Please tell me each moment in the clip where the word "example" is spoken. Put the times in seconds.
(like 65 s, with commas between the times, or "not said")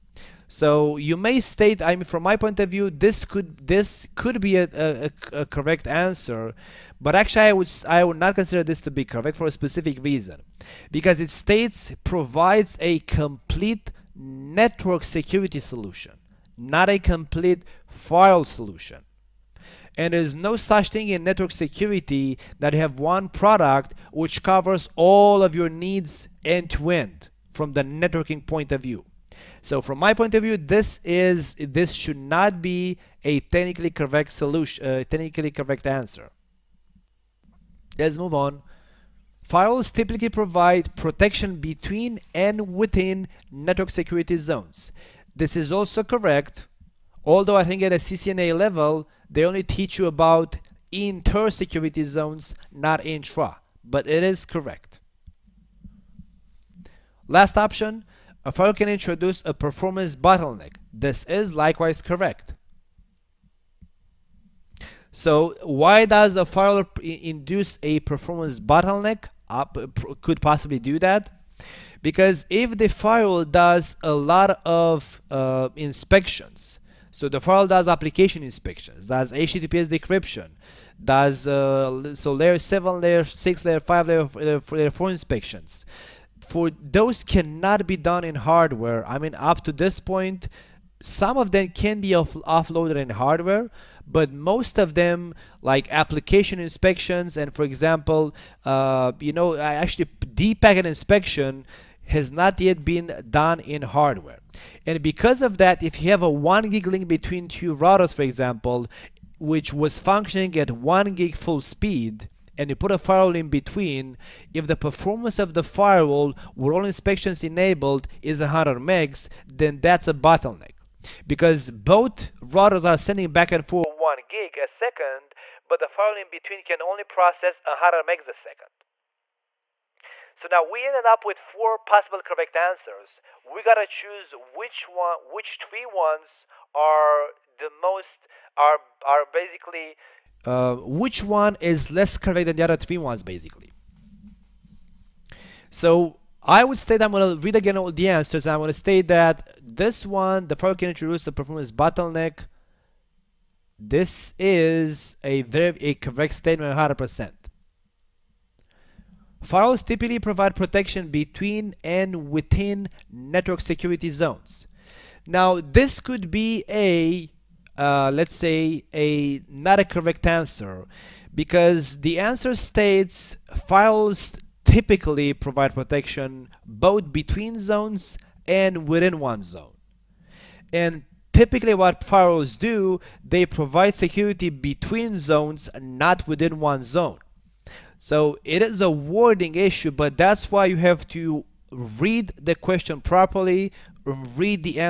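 97 s, 108 s.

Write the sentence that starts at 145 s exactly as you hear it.
So I would state I'm gonna read again all the answers.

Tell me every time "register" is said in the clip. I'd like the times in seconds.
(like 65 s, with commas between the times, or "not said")
not said.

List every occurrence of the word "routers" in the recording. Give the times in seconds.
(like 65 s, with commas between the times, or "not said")
107 s, 122 s.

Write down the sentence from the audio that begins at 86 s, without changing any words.
For those cannot be done in hardware.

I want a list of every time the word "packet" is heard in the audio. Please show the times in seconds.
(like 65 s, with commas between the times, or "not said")
100 s.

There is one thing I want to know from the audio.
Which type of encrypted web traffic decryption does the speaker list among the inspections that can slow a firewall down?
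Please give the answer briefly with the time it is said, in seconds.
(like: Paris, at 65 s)
HTTPS, at 79 s.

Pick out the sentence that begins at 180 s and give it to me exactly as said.
And typically what firewalls do, they provide security between zones, not within one zone.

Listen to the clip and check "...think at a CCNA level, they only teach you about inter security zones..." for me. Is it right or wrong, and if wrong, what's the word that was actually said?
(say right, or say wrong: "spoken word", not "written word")
right.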